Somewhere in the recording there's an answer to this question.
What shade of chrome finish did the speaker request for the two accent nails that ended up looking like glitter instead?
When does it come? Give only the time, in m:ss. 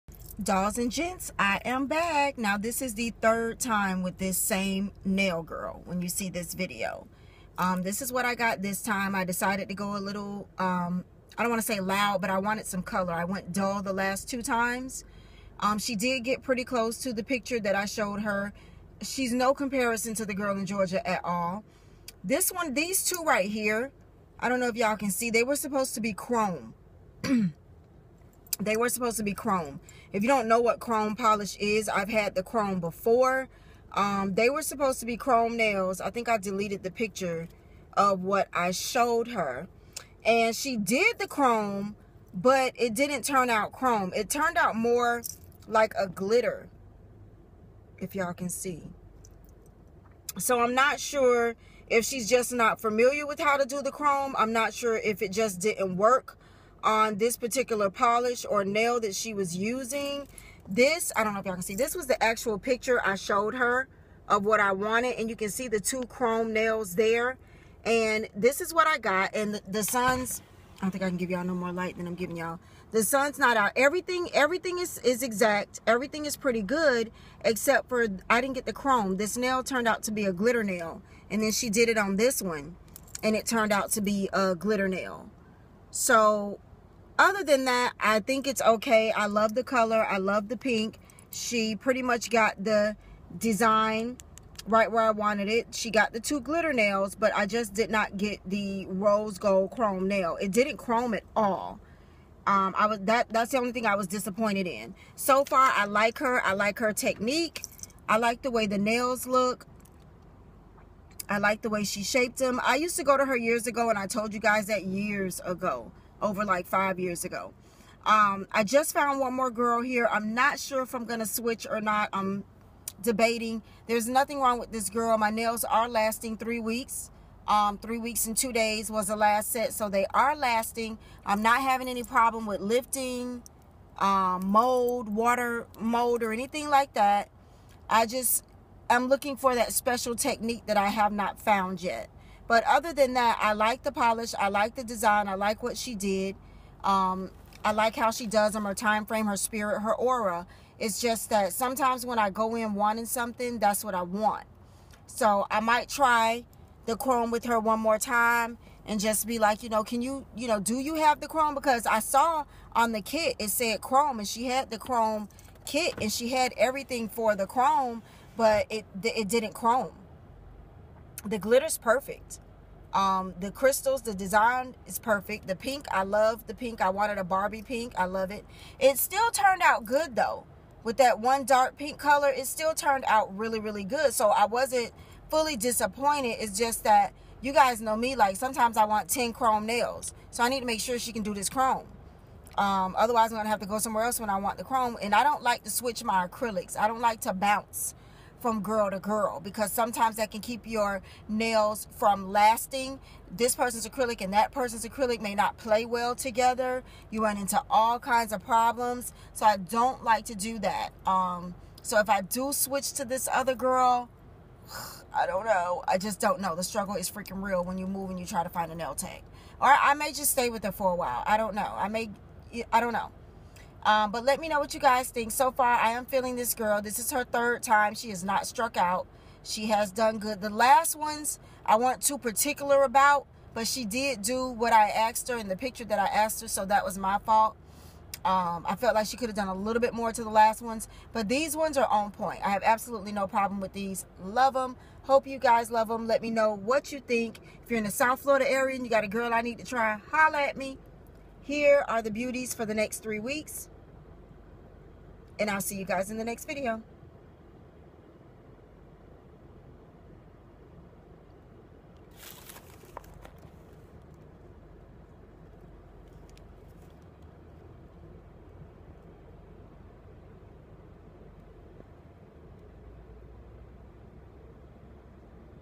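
1:38.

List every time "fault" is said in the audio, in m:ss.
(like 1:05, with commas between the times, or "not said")
3:57.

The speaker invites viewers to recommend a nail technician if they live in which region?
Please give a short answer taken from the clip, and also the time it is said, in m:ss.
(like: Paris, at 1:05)
South Florida, at 4:07.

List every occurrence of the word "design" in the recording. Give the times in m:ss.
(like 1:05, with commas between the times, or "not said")
1:33, 2:24, 2:54.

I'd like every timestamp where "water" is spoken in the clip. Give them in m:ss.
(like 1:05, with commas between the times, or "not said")
2:15.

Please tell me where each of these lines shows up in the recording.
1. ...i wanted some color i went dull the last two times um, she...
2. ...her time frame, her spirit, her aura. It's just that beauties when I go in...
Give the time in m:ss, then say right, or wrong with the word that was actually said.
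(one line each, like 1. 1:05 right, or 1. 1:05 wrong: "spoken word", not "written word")
1. 0:12 right
2. 2:28 wrong: "sometimes", not "beauties".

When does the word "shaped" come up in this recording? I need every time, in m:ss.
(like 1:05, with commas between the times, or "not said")
1:52.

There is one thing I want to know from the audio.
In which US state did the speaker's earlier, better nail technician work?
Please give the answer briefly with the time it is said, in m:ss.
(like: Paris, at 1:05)
Georgia, at 0:20.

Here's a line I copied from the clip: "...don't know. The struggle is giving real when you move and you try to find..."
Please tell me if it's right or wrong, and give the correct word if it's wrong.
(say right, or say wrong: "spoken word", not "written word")
wrong: "freaking", not "giving".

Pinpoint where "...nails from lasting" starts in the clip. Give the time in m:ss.
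3:21.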